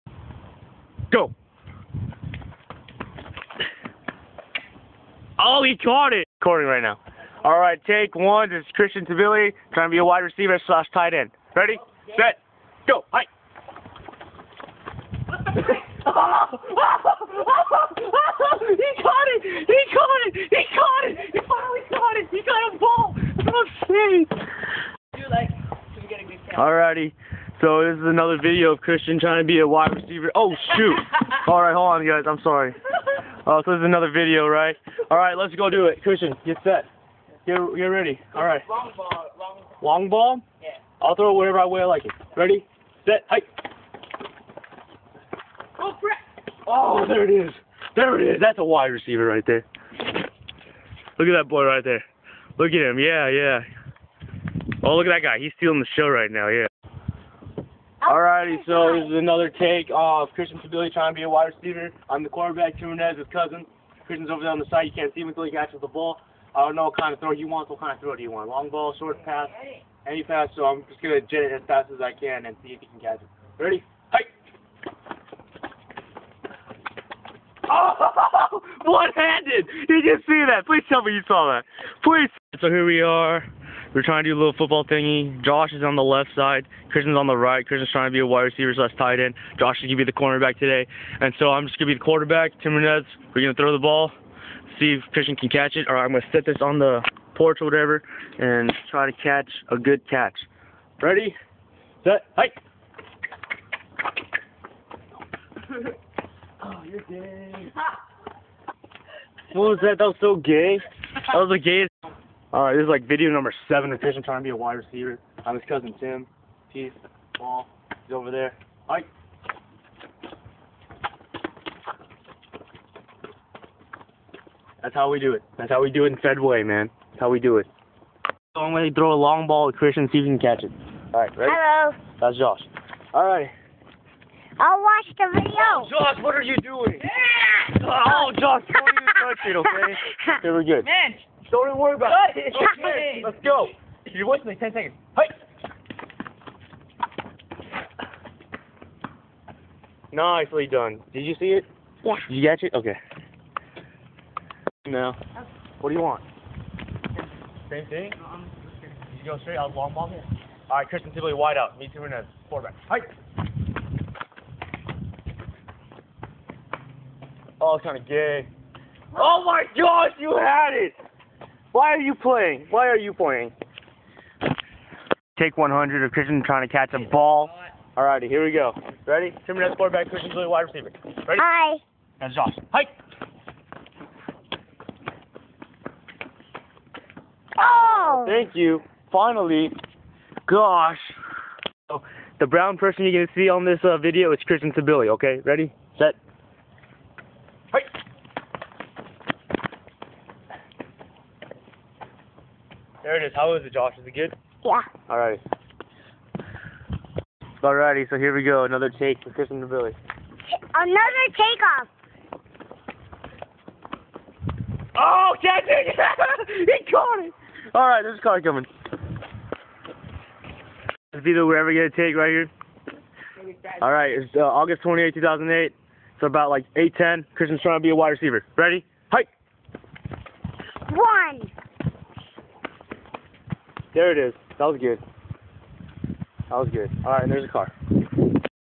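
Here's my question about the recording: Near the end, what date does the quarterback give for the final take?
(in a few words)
August 28, 2008.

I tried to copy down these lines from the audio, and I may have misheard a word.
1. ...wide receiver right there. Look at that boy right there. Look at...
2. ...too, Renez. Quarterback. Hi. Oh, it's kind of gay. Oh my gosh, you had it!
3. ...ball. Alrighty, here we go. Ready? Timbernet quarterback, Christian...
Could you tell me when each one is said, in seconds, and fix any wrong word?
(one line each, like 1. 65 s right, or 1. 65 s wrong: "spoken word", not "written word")
1. 48 s right
2. 161 s right
3. 177 s right.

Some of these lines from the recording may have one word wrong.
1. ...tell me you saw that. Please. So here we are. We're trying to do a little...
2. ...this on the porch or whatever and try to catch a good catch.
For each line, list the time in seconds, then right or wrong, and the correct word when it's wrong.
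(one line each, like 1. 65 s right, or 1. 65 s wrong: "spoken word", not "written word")
1. 80 s right
2. 96 s right.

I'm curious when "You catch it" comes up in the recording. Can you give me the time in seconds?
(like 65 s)
152 s.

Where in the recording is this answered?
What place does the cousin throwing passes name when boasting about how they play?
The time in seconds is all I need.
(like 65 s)
126 s.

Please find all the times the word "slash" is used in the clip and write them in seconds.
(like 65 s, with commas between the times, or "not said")
10 s, 88 s.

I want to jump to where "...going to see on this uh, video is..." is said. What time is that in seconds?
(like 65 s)
193 s.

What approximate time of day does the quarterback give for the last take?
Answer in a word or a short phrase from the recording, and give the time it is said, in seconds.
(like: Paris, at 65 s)
8:10, at 226 s.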